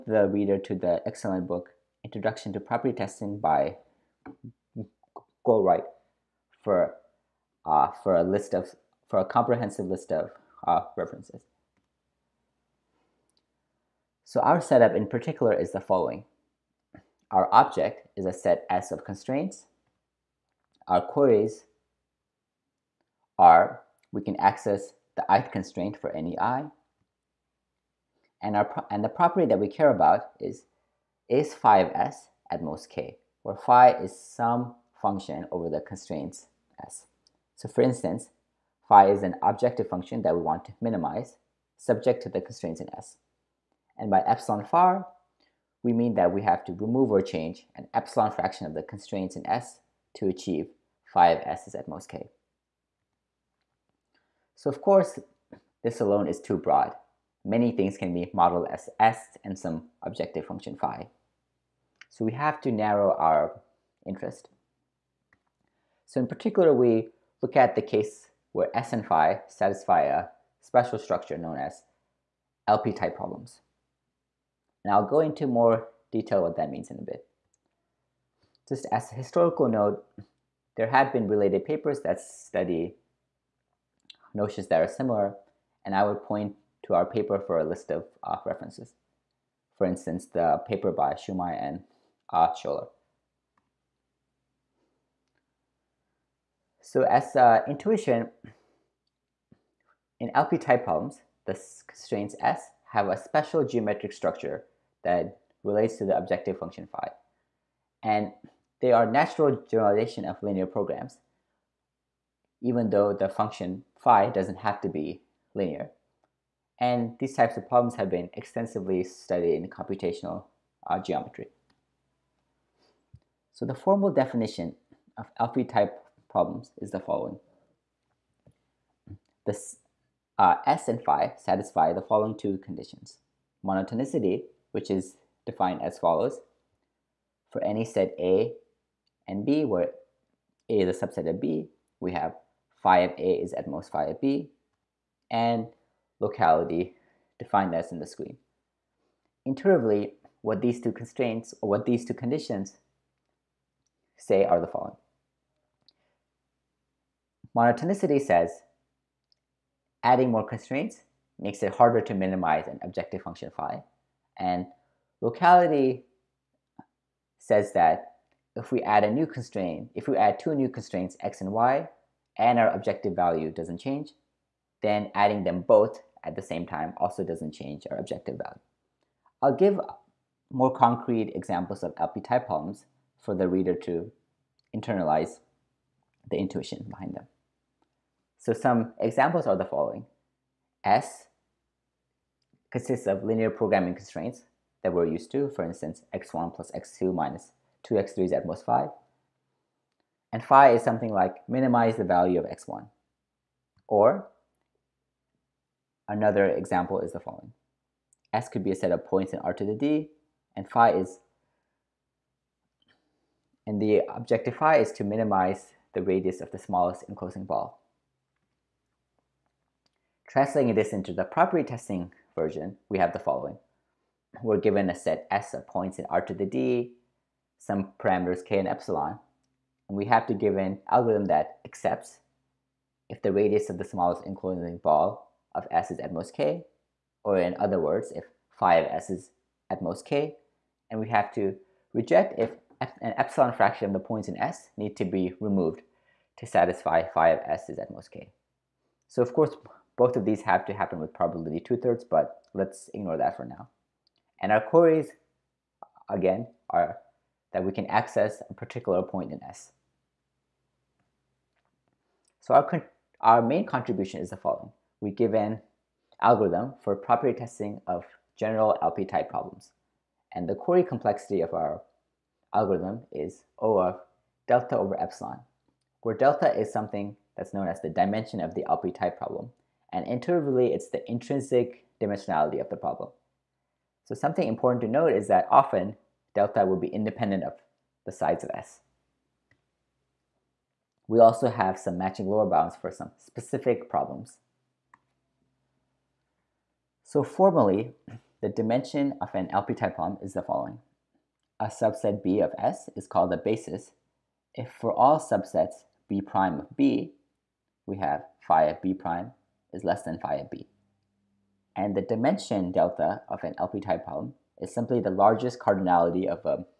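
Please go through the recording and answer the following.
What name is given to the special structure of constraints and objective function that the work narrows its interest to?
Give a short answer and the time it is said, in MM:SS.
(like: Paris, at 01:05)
LP-type problems, at 01:12.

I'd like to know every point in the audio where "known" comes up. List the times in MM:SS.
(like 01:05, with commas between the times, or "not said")
01:11, 04:37.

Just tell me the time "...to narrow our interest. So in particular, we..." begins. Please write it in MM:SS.
01:02.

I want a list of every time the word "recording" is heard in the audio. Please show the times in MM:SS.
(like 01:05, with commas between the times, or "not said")
not said.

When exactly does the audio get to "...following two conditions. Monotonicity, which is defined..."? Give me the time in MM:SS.
02:12.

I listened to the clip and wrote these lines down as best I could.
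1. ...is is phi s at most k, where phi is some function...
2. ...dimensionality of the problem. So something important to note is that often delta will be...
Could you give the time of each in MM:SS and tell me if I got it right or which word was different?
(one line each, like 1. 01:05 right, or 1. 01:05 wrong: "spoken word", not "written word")
1. 00:30 right
2. 04:42 right.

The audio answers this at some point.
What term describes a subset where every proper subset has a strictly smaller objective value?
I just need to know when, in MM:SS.
05:03.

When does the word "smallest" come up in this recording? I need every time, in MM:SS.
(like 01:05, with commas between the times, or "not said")
03:36, 03:53.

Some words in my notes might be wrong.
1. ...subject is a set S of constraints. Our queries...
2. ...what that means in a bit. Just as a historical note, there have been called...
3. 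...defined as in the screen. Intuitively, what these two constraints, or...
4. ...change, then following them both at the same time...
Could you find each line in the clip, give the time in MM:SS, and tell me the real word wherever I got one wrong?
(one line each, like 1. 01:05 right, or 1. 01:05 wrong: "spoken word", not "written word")
1. 00:17 wrong: "object", not "subject"
2. 01:16 wrong: "related", not "called"
3. 02:27 right
4. 02:53 wrong: "adding", not "following".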